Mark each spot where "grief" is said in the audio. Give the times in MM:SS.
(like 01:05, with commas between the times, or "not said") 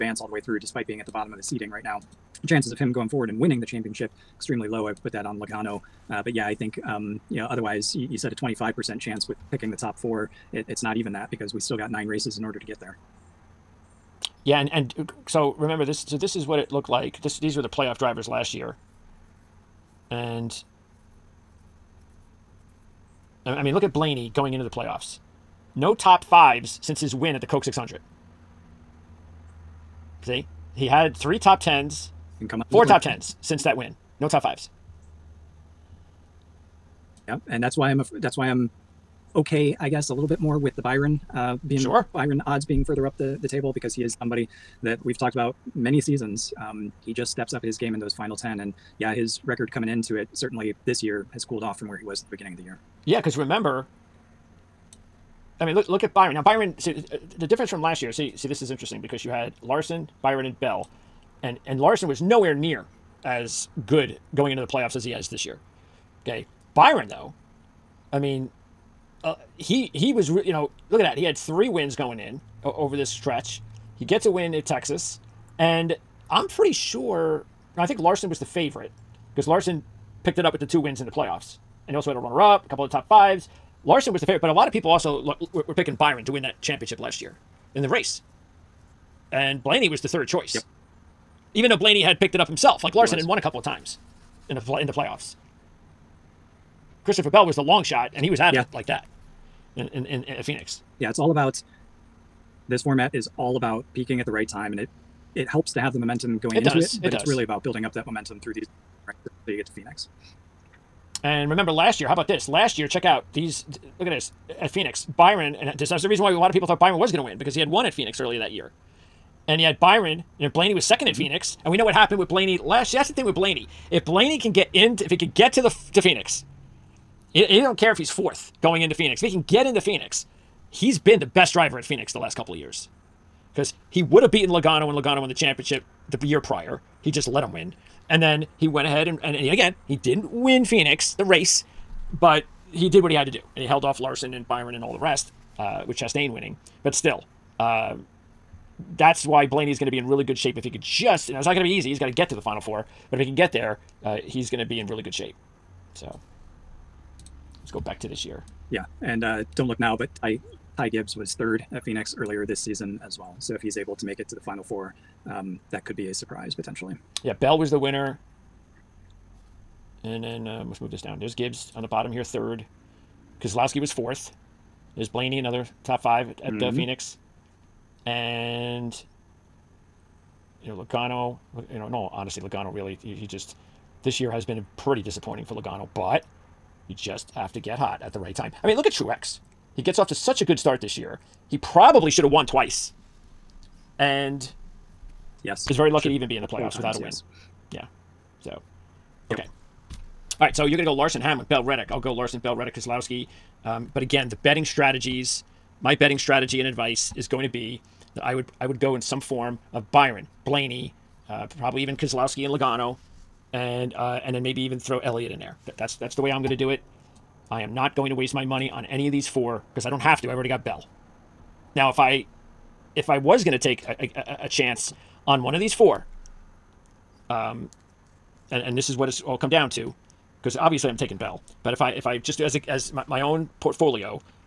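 not said.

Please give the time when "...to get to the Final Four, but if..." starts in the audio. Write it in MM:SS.
02:32.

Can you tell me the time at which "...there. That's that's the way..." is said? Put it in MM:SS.
03:35.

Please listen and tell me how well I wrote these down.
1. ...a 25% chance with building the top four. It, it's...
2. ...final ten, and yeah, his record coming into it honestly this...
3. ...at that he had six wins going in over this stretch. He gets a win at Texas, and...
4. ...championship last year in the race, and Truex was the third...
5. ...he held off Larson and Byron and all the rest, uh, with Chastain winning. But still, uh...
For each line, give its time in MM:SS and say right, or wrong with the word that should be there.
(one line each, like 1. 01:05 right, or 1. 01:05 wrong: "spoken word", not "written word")
1. 00:08 wrong: "picking", not "building"
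2. 00:48 wrong: "certainly", not "honestly"
3. 01:10 wrong: "three", not "six"
4. 01:26 wrong: "Blaney", not "Truex"
5. 02:23 right.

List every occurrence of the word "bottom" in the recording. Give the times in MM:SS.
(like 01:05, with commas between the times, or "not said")
00:01, 02:51.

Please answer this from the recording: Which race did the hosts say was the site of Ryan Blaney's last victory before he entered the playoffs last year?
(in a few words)
Coke 600.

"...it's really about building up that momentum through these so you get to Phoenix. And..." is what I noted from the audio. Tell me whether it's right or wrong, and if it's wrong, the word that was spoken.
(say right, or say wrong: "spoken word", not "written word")
right.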